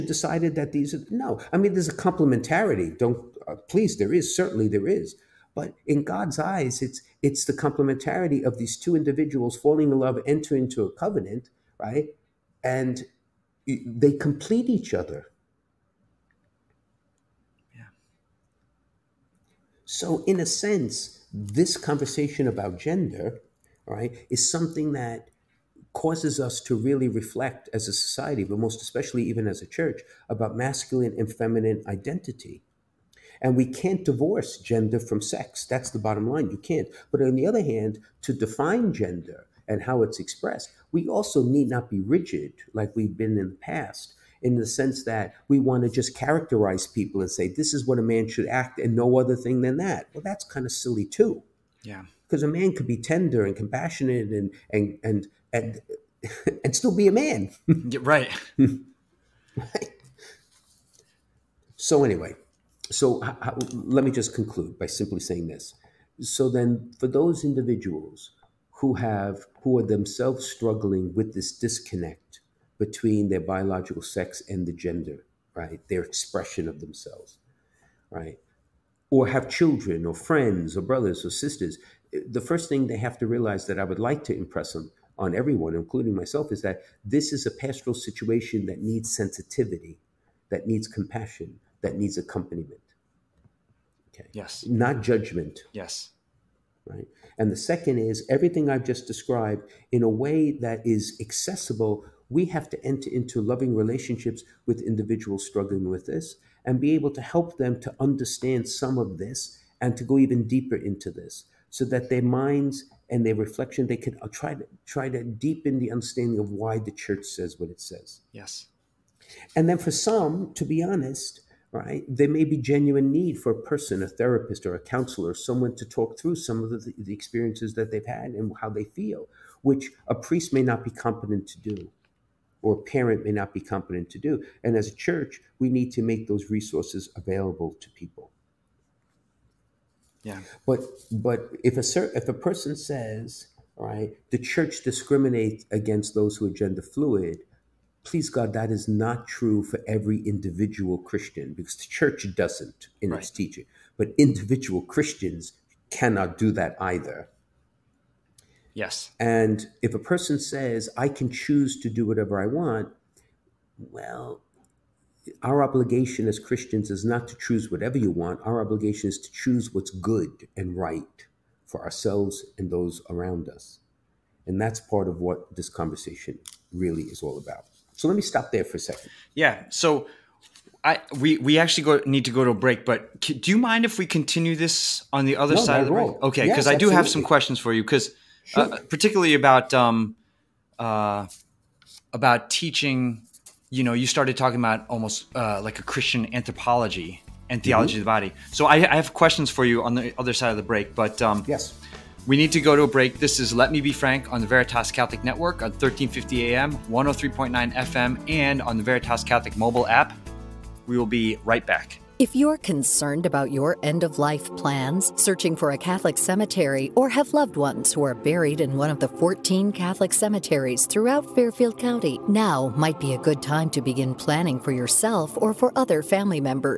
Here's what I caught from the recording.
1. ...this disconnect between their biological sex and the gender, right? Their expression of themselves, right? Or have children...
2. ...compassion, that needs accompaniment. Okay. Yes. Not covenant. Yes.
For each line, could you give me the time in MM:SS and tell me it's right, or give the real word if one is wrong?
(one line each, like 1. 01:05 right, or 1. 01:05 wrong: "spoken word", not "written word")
1. 01:11 right
2. 01:30 wrong: "judgment", not "covenant".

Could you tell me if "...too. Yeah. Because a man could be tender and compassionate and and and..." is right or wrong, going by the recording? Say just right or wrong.
right.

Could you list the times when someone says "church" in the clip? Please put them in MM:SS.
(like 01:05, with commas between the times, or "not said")
00:29, 01:56, 02:14, 02:24, 02:31.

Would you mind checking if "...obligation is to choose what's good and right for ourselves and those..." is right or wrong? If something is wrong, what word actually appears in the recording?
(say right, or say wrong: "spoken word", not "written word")
right.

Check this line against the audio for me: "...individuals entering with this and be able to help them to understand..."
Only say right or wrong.
wrong.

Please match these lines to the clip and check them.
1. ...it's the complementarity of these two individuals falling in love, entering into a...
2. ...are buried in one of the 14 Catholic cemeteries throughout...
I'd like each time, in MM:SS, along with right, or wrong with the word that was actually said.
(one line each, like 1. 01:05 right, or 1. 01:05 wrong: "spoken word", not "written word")
1. 00:07 right
2. 03:38 right.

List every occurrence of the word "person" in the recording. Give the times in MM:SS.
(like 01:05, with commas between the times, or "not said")
02:03, 02:22, 02:39.